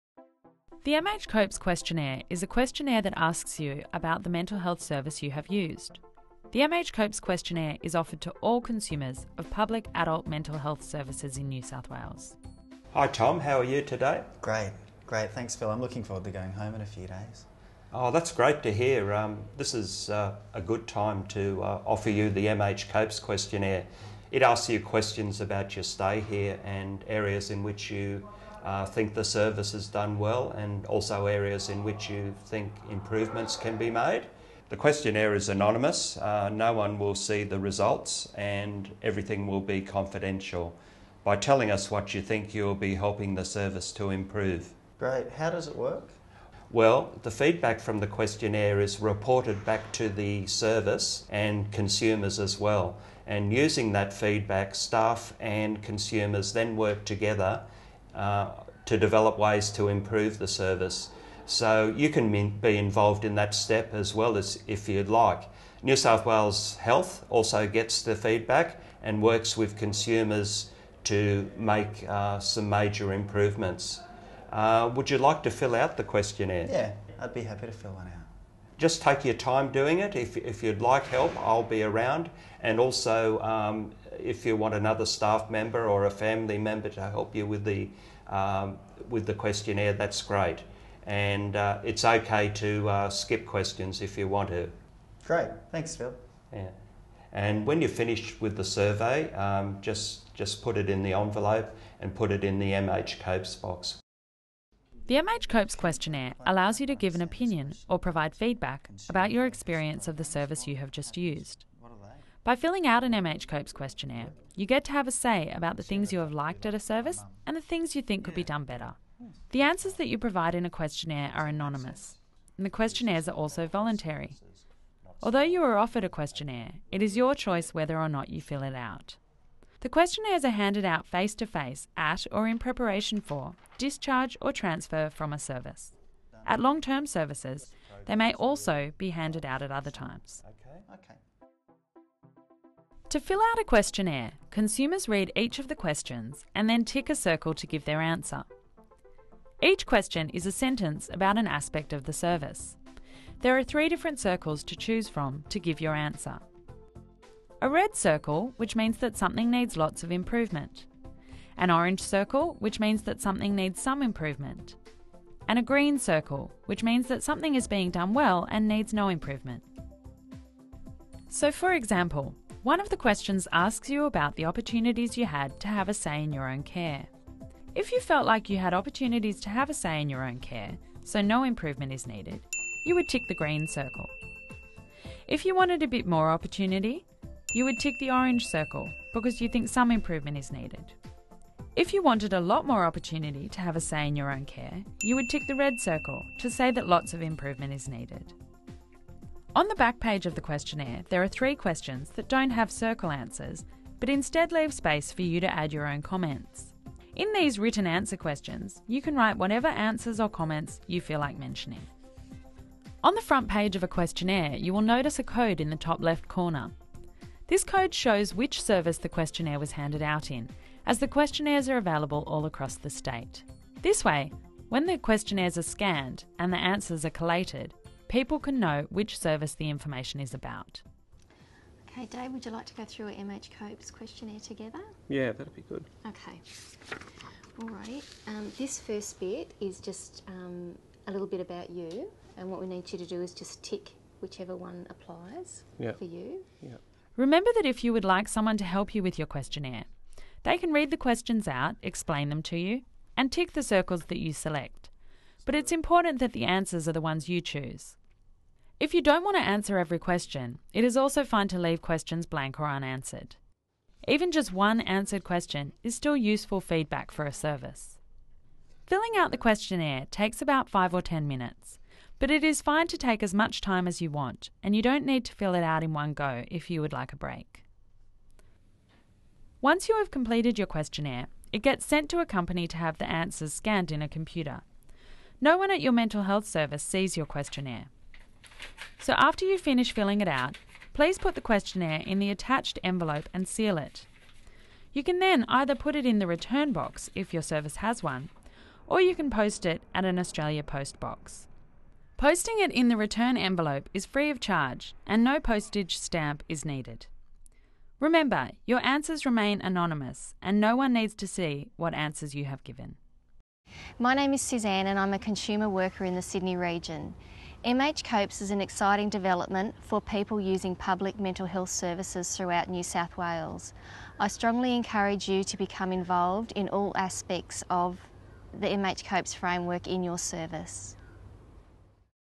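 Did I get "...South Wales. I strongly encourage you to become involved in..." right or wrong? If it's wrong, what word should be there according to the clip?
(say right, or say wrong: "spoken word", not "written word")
right.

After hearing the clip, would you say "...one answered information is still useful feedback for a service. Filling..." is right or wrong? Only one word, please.
wrong.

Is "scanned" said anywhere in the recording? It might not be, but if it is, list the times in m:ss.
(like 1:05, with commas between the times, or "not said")
3:45, 4:43.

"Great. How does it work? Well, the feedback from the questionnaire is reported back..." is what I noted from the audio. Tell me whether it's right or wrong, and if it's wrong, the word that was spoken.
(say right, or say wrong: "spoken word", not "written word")
right.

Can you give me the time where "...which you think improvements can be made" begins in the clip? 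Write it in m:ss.
0:31.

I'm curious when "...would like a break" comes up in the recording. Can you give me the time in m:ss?
4:36.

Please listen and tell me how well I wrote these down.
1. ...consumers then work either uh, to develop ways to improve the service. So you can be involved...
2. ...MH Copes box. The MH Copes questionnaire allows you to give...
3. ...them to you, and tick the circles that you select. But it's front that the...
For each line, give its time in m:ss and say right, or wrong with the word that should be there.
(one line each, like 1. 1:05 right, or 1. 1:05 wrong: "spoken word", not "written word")
1. 0:55 wrong: "together", not "either"
2. 1:42 right
3. 4:12 wrong: "important", not "front".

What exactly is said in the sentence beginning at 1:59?
The answers that you provide in a questionnaire are anonymous, and the questionnaires are also voluntary.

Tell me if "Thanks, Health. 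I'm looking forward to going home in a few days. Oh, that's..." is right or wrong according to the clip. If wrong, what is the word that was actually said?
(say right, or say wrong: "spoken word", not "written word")
wrong: "Phil", not "Health".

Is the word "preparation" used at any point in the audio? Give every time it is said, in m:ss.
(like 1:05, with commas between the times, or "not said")
2:12.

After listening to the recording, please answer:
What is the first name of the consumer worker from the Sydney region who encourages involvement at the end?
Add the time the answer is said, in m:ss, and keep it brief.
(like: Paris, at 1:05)
Suzanne, at 5:14.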